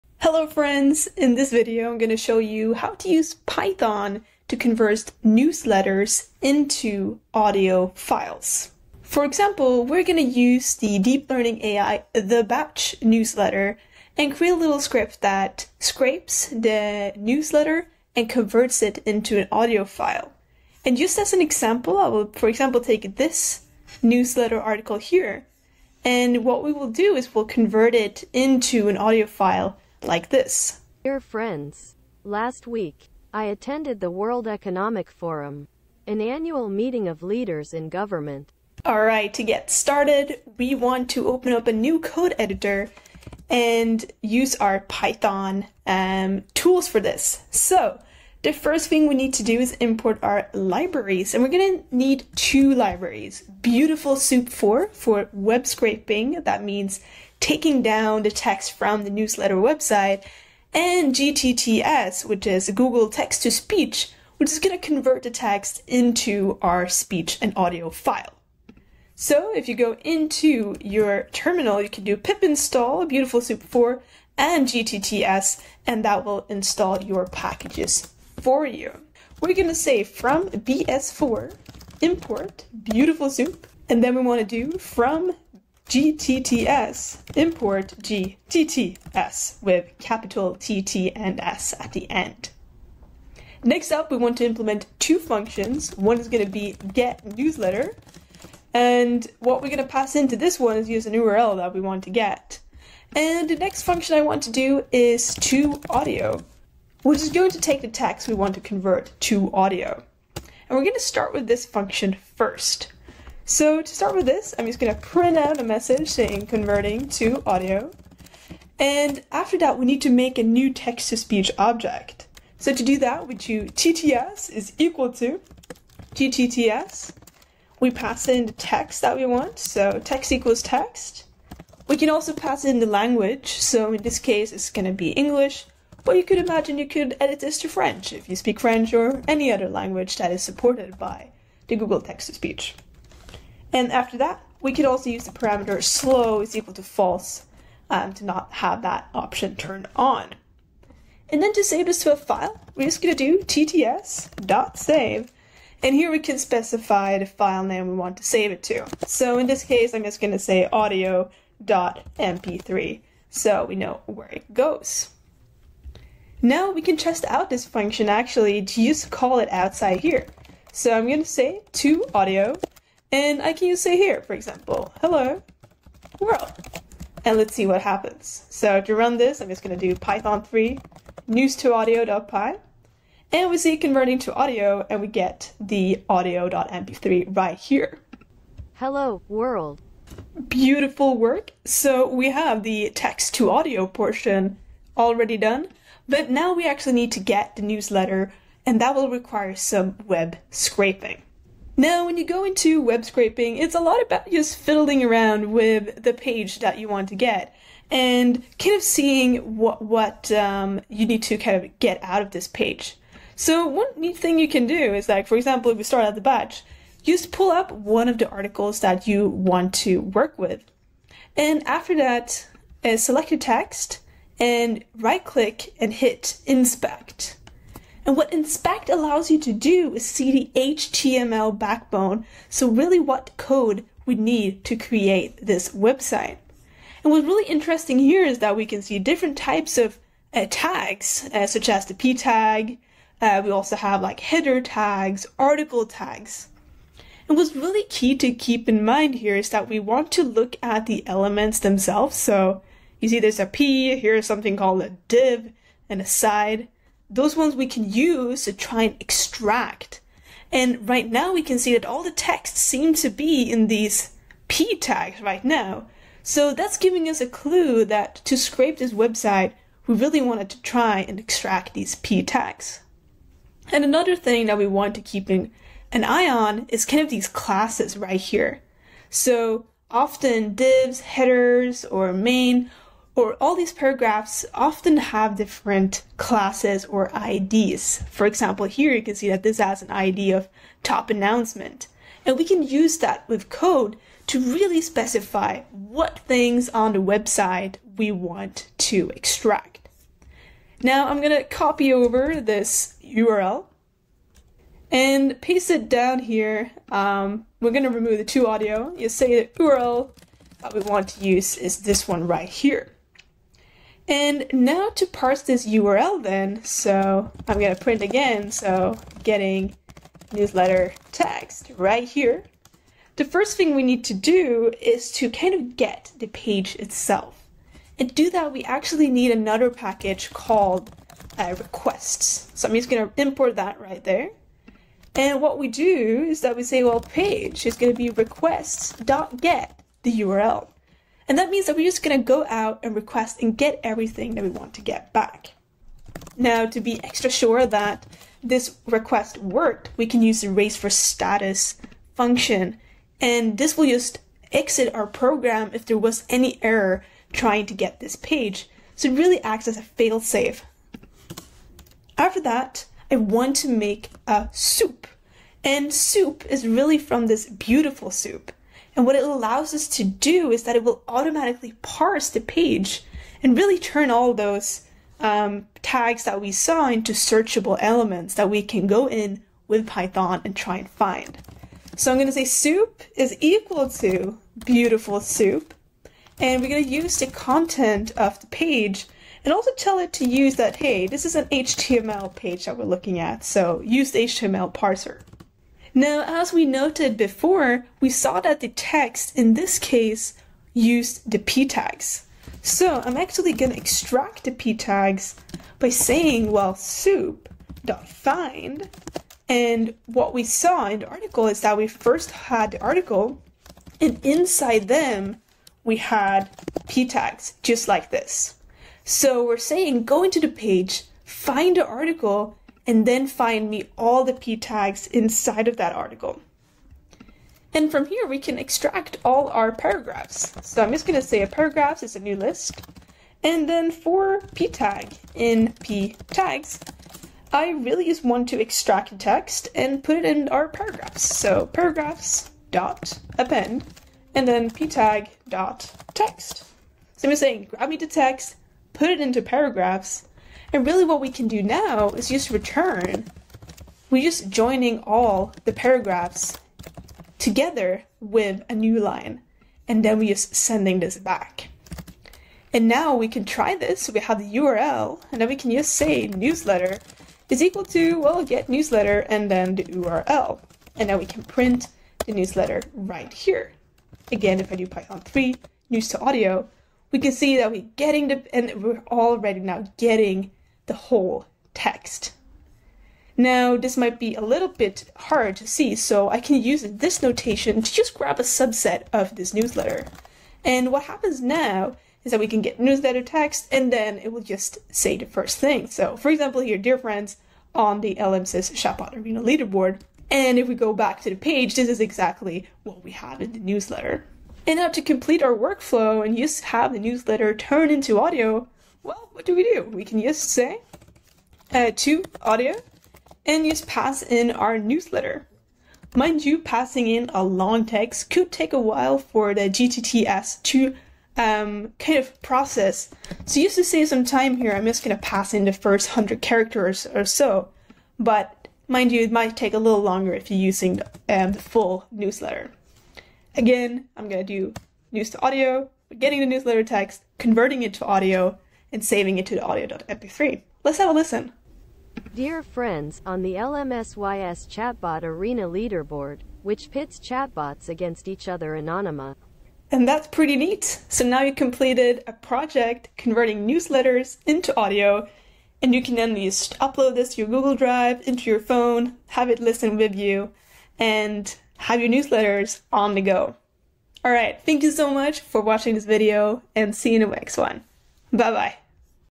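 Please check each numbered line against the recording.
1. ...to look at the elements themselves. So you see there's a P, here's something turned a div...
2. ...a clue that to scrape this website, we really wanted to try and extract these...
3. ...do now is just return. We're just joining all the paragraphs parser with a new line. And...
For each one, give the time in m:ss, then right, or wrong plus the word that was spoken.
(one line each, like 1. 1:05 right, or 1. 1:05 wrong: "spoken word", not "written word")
1. 4:10 wrong: "called", not "turned"
2. 4:27 right
3. 7:31 wrong: "together", not "parser".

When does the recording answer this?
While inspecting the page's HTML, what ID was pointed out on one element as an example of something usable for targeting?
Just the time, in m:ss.
4:50.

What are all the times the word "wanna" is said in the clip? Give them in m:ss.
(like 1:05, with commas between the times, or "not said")
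1:24.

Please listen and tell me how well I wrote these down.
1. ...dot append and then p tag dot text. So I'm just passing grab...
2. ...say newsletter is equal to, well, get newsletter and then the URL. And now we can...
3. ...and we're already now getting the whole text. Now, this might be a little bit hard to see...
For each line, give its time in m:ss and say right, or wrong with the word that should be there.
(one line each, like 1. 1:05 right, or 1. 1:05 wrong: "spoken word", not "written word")
1. 7:22 wrong: "saying", not "passing"
2. 7:45 right
3. 7:58 right.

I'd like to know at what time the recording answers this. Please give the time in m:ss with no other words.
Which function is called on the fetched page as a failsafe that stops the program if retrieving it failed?
5:50.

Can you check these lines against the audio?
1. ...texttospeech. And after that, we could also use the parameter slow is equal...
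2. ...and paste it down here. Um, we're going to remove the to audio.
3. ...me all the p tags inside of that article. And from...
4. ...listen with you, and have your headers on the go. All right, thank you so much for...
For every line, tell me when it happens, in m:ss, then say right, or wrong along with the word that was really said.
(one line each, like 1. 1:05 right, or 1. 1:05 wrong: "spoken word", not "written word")
1. 2:22 wrong: "speech", not "texttospeech"
2. 5:04 right
3. 7:03 right
4. 9:19 wrong: "newsletters", not "headers".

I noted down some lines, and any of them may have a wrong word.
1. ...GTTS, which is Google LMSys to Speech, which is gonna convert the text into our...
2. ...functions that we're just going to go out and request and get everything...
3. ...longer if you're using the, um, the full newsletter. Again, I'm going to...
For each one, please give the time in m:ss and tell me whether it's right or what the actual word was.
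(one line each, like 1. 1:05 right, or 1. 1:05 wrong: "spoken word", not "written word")
1. 1:01 wrong: "Text", not "LMSys"
2. 5:41 wrong: "means", not "functions"
3. 8:50 right.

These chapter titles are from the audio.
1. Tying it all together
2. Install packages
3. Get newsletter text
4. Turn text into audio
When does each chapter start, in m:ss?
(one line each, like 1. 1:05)
1. 8:24
2. 0:38
3. 3:16
4. 1:38.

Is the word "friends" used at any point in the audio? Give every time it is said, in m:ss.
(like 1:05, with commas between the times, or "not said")
0:00, 0:31, 8:16, 9:02.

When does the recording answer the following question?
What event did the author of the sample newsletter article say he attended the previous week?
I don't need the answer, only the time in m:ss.
0:34.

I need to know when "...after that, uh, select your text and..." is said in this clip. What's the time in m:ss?
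3:41.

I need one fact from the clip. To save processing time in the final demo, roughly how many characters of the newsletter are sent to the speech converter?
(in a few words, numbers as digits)
100.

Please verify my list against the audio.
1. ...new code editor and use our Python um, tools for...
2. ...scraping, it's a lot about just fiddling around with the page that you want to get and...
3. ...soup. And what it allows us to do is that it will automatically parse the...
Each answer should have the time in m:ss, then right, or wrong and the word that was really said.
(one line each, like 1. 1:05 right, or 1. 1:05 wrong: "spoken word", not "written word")
1. 0:41 right
2. 3:23 right
3. 6:08 right.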